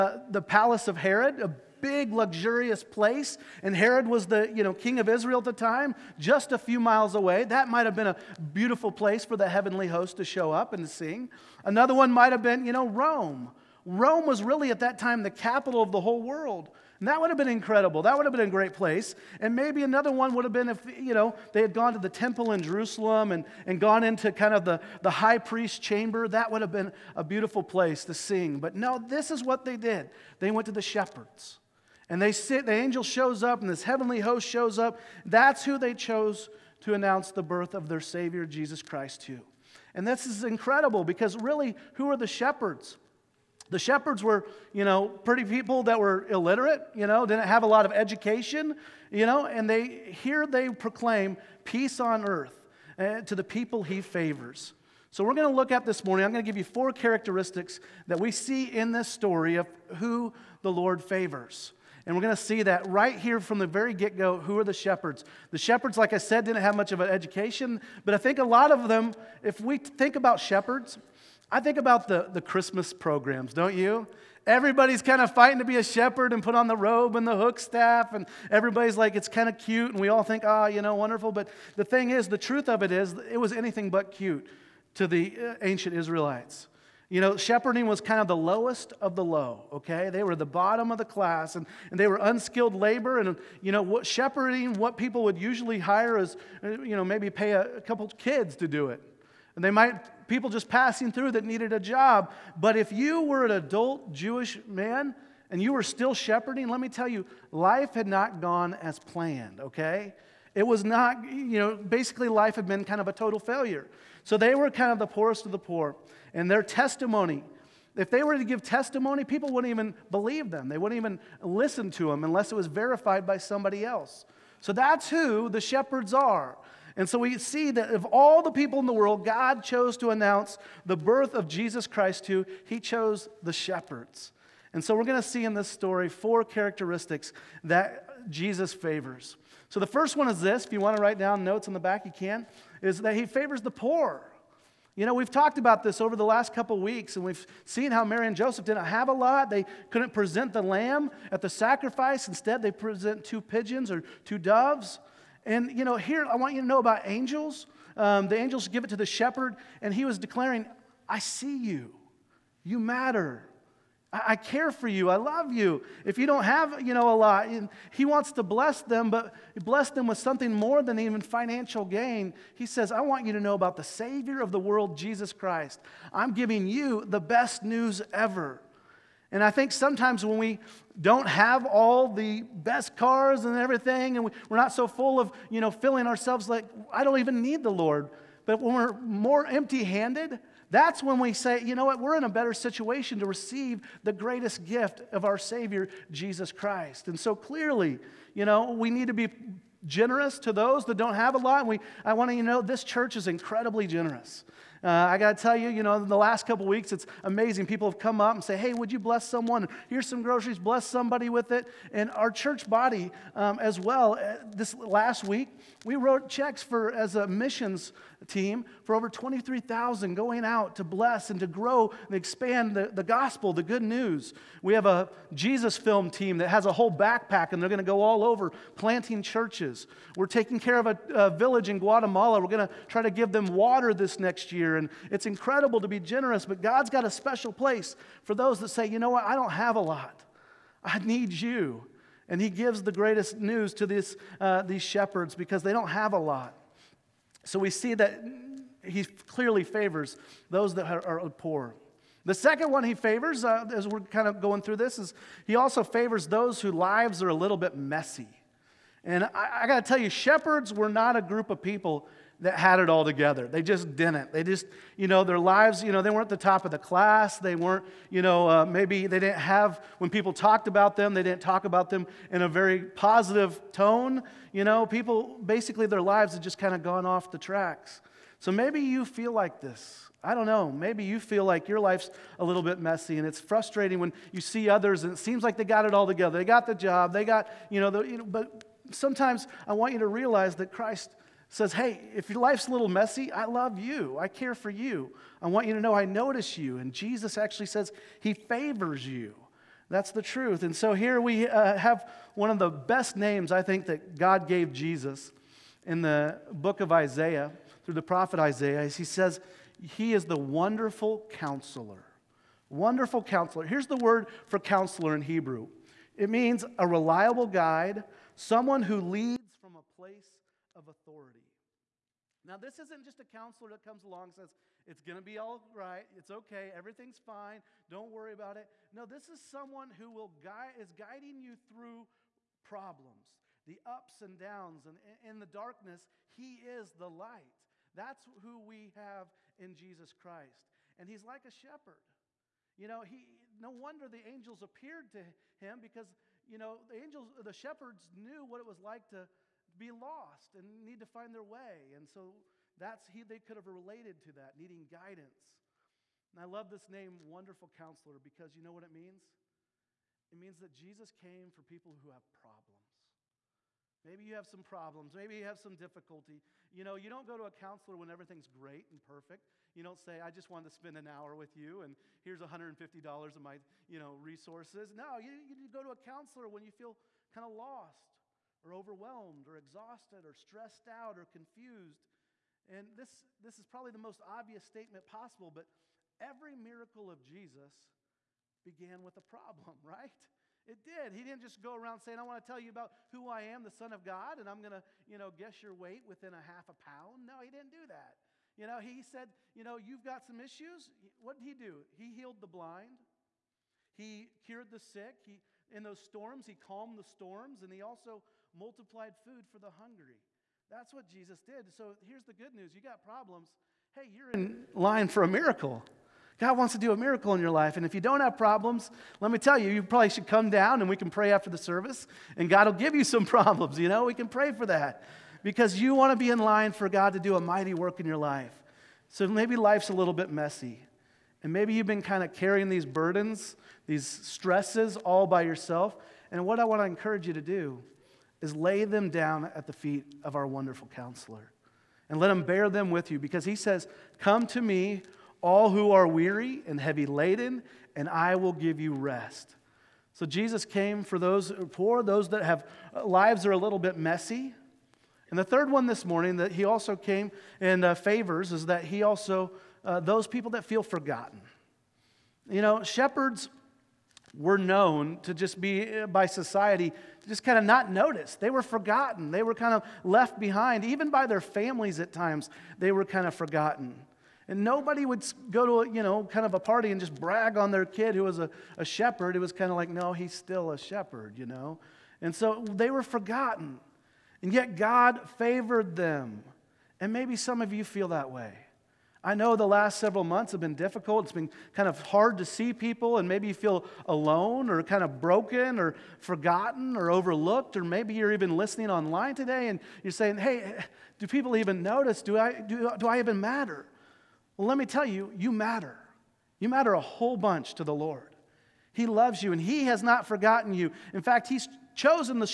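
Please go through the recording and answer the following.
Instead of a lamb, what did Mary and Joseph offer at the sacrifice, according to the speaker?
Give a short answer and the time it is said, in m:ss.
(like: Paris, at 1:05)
two pigeons or two doves, at 2:33.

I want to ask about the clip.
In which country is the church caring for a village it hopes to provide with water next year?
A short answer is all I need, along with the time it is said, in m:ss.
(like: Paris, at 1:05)
Guatemala, at 3:51.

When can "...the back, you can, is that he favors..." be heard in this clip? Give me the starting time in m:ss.
2:21.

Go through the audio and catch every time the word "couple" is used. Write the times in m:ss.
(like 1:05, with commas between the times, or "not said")
1:37, 2:26, 3:26.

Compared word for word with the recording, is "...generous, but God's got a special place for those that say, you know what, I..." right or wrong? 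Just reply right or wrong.
right.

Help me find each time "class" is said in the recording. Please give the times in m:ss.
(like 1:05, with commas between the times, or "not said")
1:31, 4:26.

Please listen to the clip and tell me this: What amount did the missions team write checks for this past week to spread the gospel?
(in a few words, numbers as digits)
23,000.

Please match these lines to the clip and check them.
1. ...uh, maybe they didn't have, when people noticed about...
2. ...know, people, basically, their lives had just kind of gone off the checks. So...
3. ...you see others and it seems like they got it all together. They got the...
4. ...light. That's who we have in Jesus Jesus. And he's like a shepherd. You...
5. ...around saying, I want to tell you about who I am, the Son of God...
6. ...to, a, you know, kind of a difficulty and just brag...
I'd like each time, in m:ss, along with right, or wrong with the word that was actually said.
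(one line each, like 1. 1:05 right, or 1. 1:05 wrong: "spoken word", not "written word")
1. 4:28 wrong: "talked", not "noticed"
2. 4:34 wrong: "tracks", not "checks"
3. 4:44 right
4. 5:37 wrong: "Christ", not "Jesus"
5. 6:31 right
6. 7:55 wrong: "party", not "difficulty".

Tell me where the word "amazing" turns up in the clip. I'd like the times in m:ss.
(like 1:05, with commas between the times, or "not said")
3:27.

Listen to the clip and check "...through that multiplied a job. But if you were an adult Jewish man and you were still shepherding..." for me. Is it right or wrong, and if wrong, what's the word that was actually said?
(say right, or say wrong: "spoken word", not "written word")
wrong: "needed", not "multiplied".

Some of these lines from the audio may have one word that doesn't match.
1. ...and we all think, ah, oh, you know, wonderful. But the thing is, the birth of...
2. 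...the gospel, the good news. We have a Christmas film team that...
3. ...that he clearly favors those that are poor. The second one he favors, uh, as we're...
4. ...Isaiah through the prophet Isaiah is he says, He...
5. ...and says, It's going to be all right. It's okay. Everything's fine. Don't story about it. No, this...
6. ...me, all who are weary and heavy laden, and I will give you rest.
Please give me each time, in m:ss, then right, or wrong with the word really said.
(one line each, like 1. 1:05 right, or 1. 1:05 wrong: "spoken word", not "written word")
1. 1:19 wrong: "truth", not "birth"
2. 3:42 wrong: "Jesus", not "Christmas"
3. 4:07 right
4. 5:06 right
5. 5:24 wrong: "worry", not "story"
6. 7:24 right.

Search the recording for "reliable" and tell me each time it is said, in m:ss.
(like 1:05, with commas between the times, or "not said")
5:16.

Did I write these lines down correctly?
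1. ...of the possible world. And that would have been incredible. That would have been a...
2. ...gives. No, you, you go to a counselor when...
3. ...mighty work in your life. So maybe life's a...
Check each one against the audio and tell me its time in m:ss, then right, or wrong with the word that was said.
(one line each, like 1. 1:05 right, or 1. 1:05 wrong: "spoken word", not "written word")
1. 0:15 wrong: "whole", not "possible"
2. 6:14 wrong: "resources", not "gives"
3. 7:07 right.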